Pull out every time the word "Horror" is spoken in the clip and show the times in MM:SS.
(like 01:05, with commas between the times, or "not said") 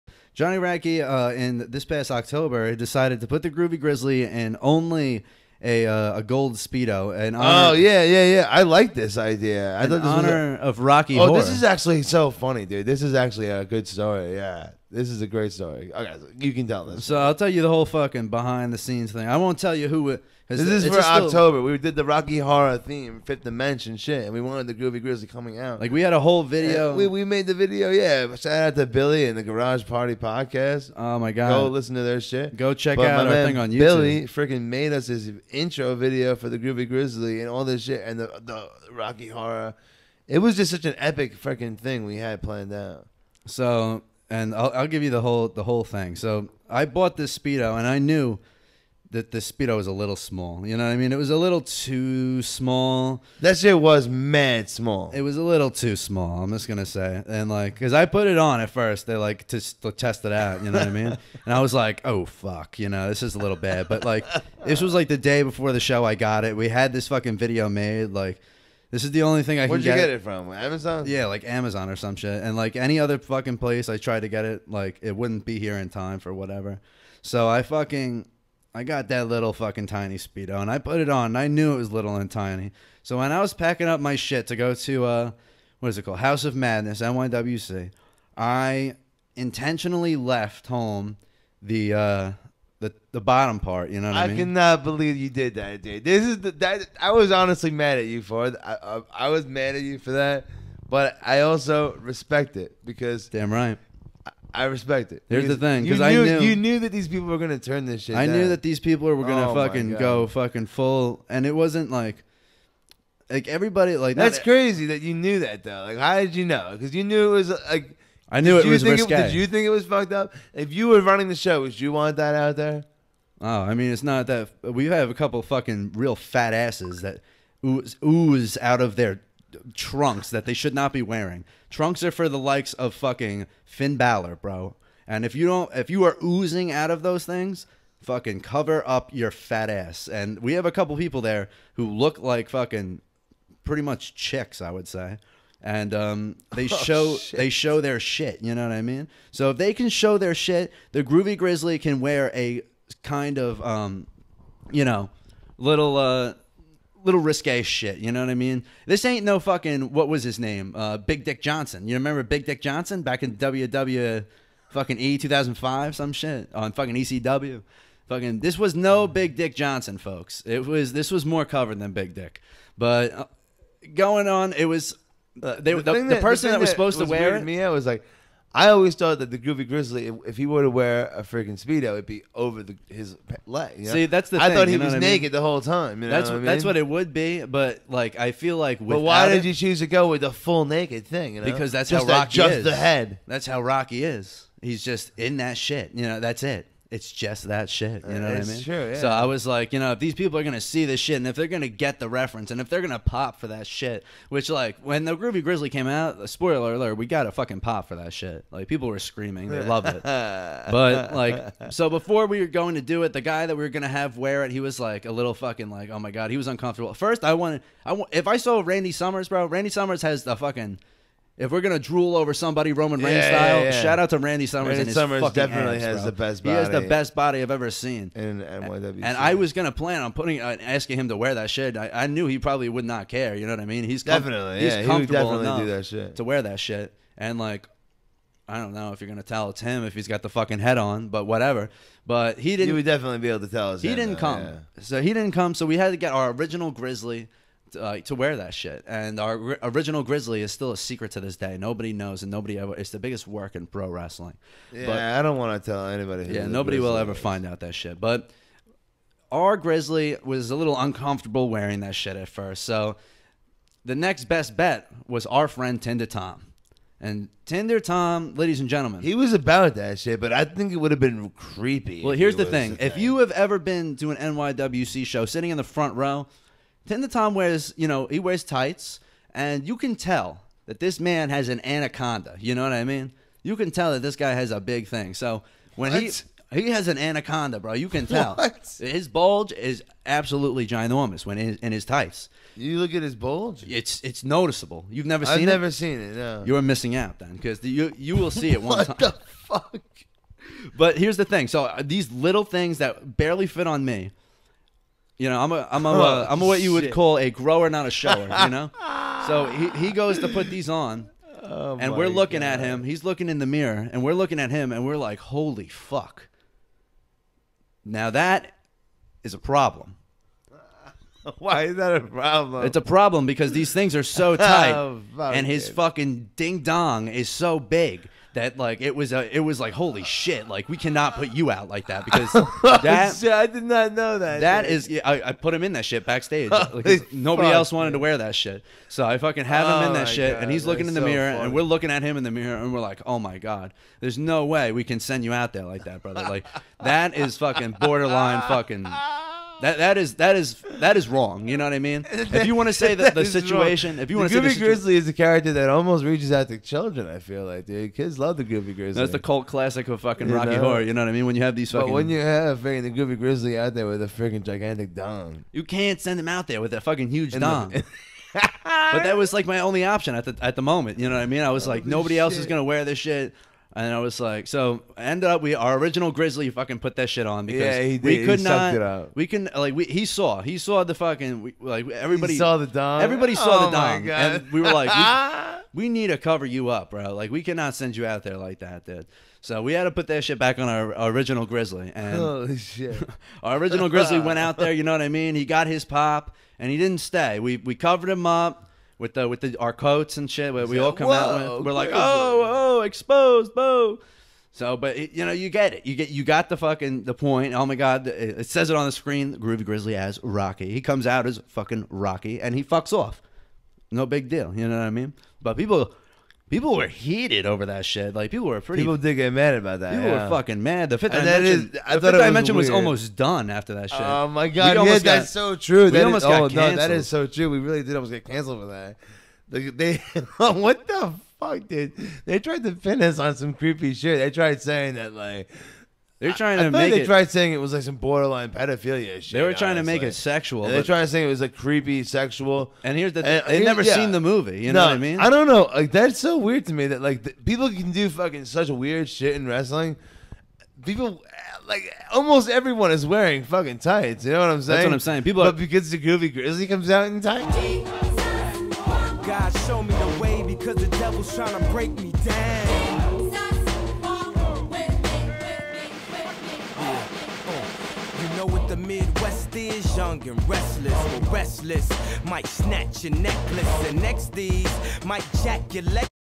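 00:11, 00:22, 00:39, 06:00.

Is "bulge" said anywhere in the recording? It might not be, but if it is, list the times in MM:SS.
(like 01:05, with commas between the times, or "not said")
04:49, 04:53.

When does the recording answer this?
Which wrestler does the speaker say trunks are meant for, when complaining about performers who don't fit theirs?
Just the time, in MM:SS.
02:13.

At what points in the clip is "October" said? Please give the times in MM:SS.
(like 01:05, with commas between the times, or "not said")
00:02, 00:20.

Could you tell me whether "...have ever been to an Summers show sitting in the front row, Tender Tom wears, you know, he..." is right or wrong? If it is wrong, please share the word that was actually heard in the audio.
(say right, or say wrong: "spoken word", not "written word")
wrong: "NYWC", not "Summers".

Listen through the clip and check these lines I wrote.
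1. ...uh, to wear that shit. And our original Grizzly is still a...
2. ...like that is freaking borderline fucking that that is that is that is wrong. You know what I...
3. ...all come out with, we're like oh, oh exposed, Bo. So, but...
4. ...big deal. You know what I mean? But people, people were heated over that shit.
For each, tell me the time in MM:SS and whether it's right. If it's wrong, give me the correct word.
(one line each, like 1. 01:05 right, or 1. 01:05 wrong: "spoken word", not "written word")
1. 04:07 right
2. 05:46 wrong: "fucking", not "freaking"
3. 06:40 right
4. 06:54 right.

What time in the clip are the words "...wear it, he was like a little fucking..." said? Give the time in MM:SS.
03:34.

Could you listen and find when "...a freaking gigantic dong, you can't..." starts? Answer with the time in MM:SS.
06:04.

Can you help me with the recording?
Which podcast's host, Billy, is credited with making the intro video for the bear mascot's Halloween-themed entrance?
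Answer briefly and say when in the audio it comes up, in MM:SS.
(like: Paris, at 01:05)
Garage Party Podcast, at 00:29.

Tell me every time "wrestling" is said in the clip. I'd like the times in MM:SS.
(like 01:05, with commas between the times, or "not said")
04:13, 07:29.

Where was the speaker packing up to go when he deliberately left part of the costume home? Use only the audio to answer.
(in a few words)
House of Madness.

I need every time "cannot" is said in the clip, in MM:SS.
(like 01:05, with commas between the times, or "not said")
01:34, 05:30, 06:27.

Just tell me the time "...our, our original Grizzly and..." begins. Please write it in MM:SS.
06:30.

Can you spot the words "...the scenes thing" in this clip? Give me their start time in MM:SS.
00:18.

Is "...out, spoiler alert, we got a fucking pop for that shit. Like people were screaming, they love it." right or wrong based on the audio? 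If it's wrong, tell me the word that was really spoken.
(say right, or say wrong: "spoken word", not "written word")
right.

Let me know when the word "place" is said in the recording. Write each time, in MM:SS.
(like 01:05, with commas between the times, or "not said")
01:13.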